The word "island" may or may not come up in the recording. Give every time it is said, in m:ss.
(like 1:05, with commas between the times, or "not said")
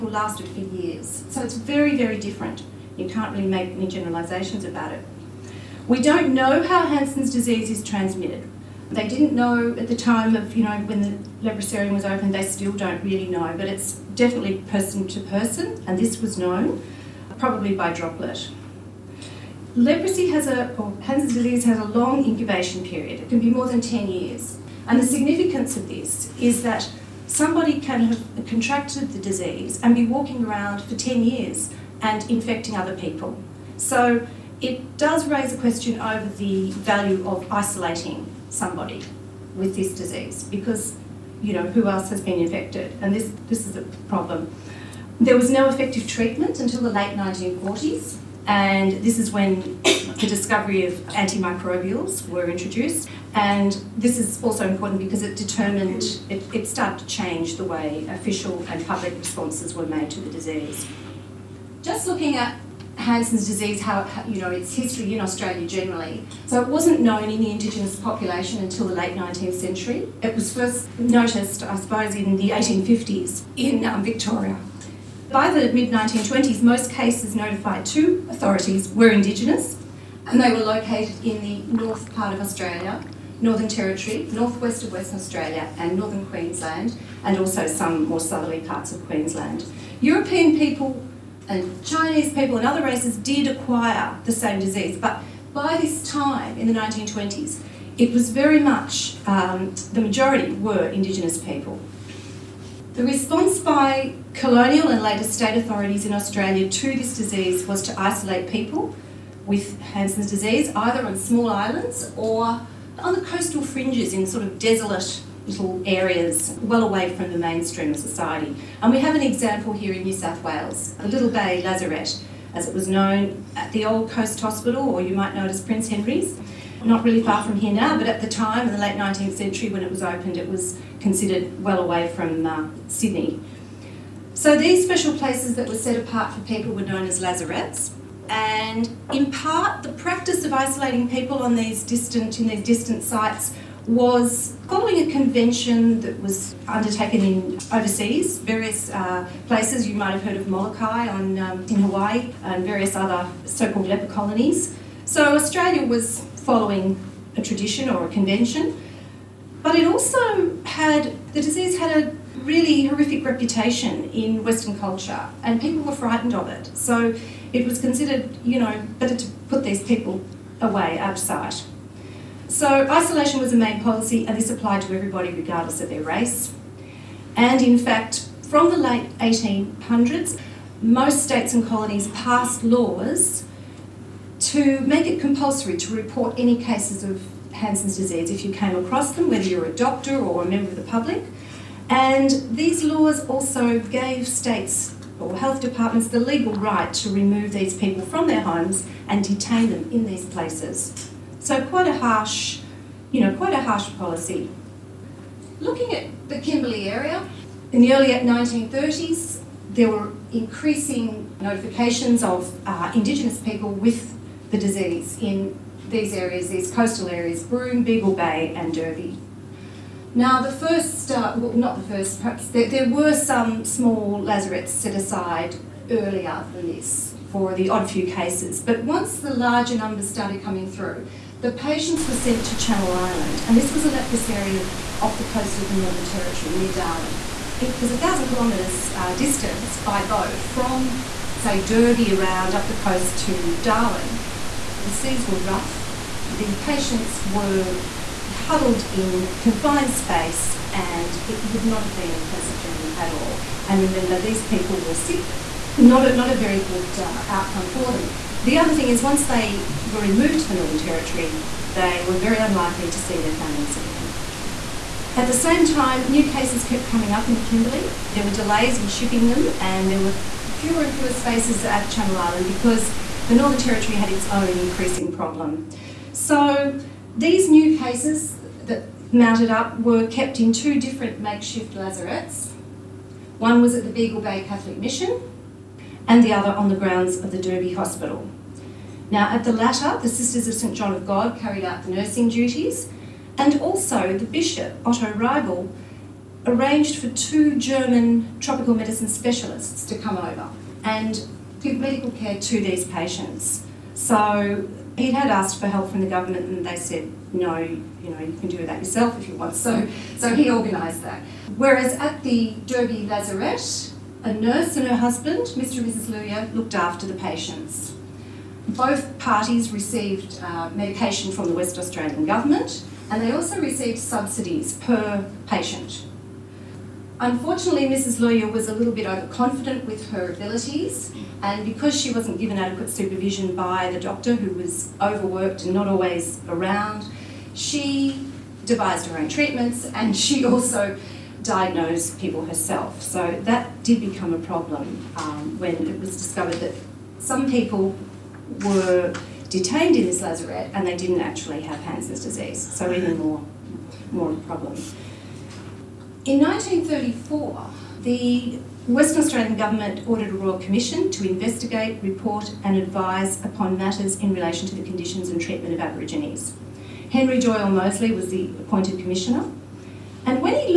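1:51, 3:52, 4:32.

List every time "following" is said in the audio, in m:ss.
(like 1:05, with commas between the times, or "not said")
2:24, 2:36.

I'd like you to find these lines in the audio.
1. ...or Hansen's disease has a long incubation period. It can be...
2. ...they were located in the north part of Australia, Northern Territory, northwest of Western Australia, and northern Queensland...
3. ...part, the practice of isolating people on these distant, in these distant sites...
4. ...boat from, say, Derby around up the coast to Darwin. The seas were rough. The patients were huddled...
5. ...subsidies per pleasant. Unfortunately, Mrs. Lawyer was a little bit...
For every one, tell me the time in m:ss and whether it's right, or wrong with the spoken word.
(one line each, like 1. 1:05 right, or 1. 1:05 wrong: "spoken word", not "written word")
1. 0:20 right
2. 1:20 right
3. 2:19 right
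4. 4:00 right
5. 5:23 wrong: "patient", not "pleasant".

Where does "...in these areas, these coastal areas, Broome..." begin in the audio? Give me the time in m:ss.
3:35.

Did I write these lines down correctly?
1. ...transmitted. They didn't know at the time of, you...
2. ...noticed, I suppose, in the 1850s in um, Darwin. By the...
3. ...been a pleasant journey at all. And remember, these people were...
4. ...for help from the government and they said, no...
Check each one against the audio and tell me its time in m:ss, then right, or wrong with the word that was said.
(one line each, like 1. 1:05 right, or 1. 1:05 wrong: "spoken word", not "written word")
1. 0:07 right
2. 1:10 wrong: "Victoria", not "Darwin"
3. 4:11 right
4. 5:05 right.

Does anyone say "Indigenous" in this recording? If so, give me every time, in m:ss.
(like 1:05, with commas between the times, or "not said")
1:07, 1:19, 1:40, 3:32.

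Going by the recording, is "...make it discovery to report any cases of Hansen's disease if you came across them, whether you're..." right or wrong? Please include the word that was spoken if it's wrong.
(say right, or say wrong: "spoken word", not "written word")
wrong: "compulsory", not "discovery".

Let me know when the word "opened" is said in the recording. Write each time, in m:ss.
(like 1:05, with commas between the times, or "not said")
0:12, 2:10.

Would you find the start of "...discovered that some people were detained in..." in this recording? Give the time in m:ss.
5:46.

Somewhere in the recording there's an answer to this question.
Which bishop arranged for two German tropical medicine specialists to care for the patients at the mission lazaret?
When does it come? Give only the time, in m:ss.
4:54.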